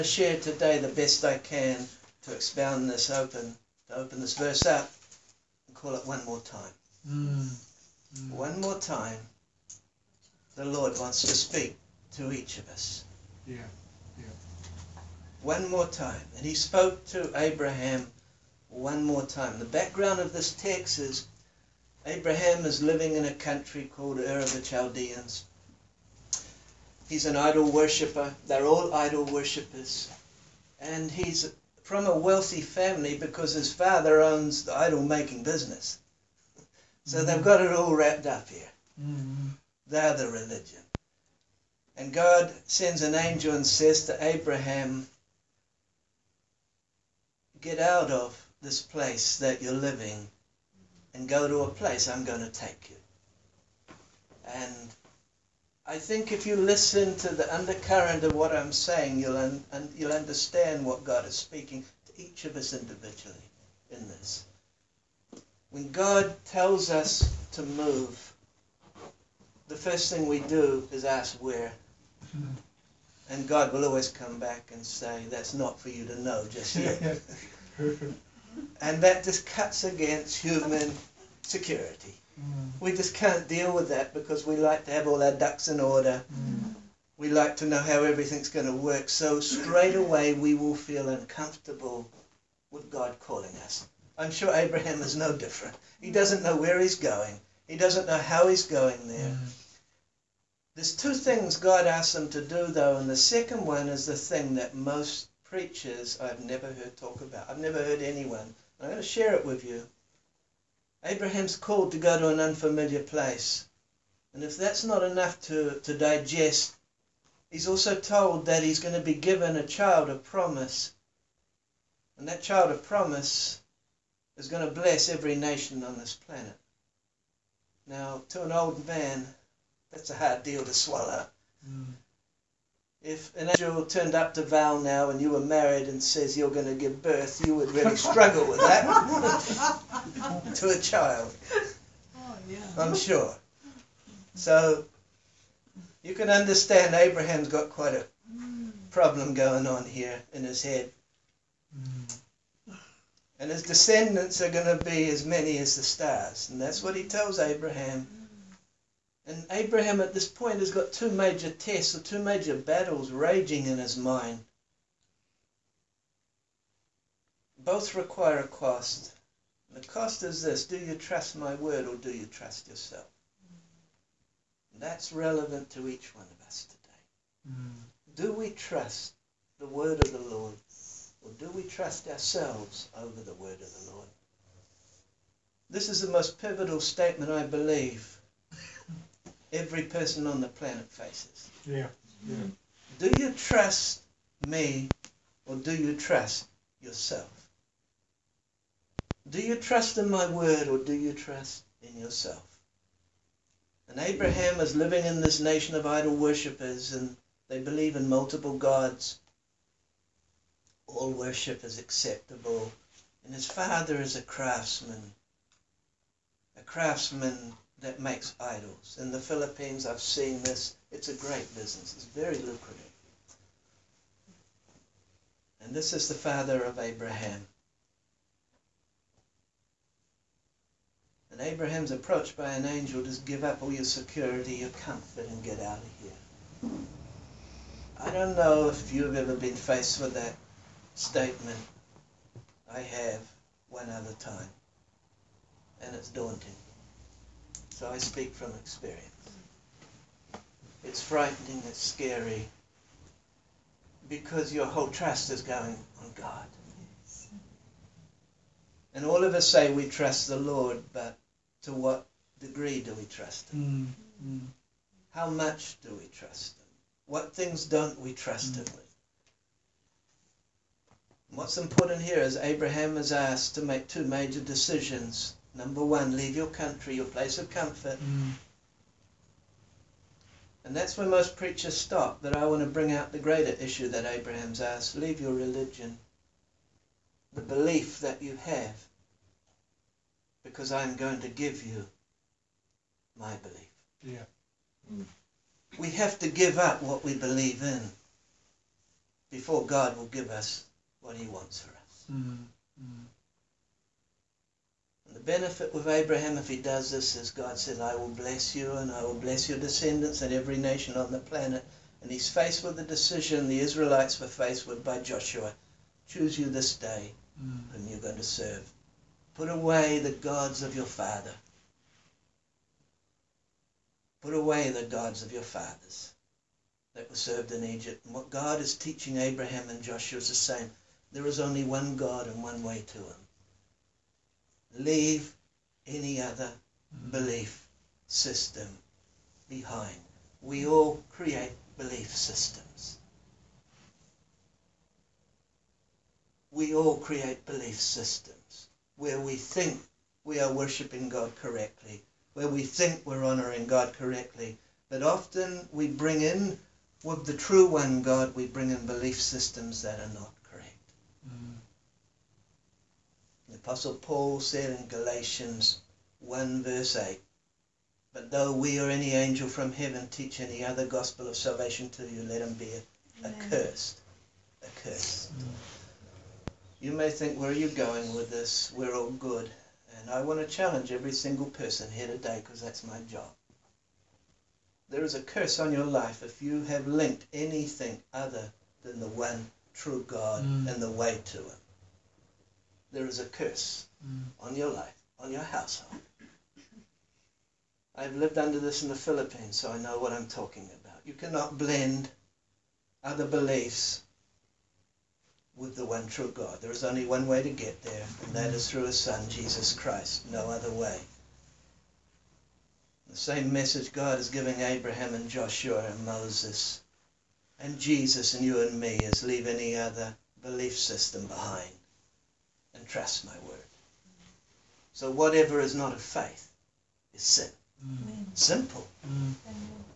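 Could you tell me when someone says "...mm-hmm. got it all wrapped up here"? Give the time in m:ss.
0:37.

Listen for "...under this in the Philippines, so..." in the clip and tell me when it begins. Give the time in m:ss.
6:38.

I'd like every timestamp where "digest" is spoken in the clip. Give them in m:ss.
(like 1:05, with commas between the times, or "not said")
1:55.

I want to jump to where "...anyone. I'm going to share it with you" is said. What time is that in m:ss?
1:48.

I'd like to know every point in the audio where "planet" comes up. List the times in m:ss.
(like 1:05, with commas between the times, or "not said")
2:06, 3:10, 5:11.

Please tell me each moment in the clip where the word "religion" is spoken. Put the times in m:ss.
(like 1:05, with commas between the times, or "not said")
0:40, 4:45.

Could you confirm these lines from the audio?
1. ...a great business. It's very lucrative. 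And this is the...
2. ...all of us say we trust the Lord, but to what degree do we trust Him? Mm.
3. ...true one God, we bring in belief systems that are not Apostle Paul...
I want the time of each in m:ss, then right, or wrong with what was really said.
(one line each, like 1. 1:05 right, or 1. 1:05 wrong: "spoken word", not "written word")
1. 3:41 right
2. 4:19 right
3. 5:57 right.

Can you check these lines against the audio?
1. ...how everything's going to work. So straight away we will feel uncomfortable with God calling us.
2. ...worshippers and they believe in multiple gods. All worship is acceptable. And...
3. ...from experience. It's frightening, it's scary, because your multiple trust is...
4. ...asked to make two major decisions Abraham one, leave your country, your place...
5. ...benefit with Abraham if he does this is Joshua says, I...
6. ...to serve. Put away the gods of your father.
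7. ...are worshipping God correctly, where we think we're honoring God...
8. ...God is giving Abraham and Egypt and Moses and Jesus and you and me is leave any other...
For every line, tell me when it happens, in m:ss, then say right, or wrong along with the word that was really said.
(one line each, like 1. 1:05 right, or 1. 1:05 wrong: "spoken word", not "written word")
1. 1:27 right
2. 3:26 right
3. 4:08 wrong: "whole", not "multiple"
4. 4:33 wrong: "Number", not "Abraham"
5. 5:05 wrong: "God", not "Joshua"
6. 5:18 right
7. 5:50 right
8. 6:53 wrong: "Joshua", not "Egypt".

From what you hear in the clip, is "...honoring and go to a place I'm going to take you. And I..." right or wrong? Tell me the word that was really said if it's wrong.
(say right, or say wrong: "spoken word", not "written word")
wrong: "living", not "honoring".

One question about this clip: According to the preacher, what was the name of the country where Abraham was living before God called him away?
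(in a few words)
Ur of the Chaldeans.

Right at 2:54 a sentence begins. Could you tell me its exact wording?
And that's relevant to each one of us today.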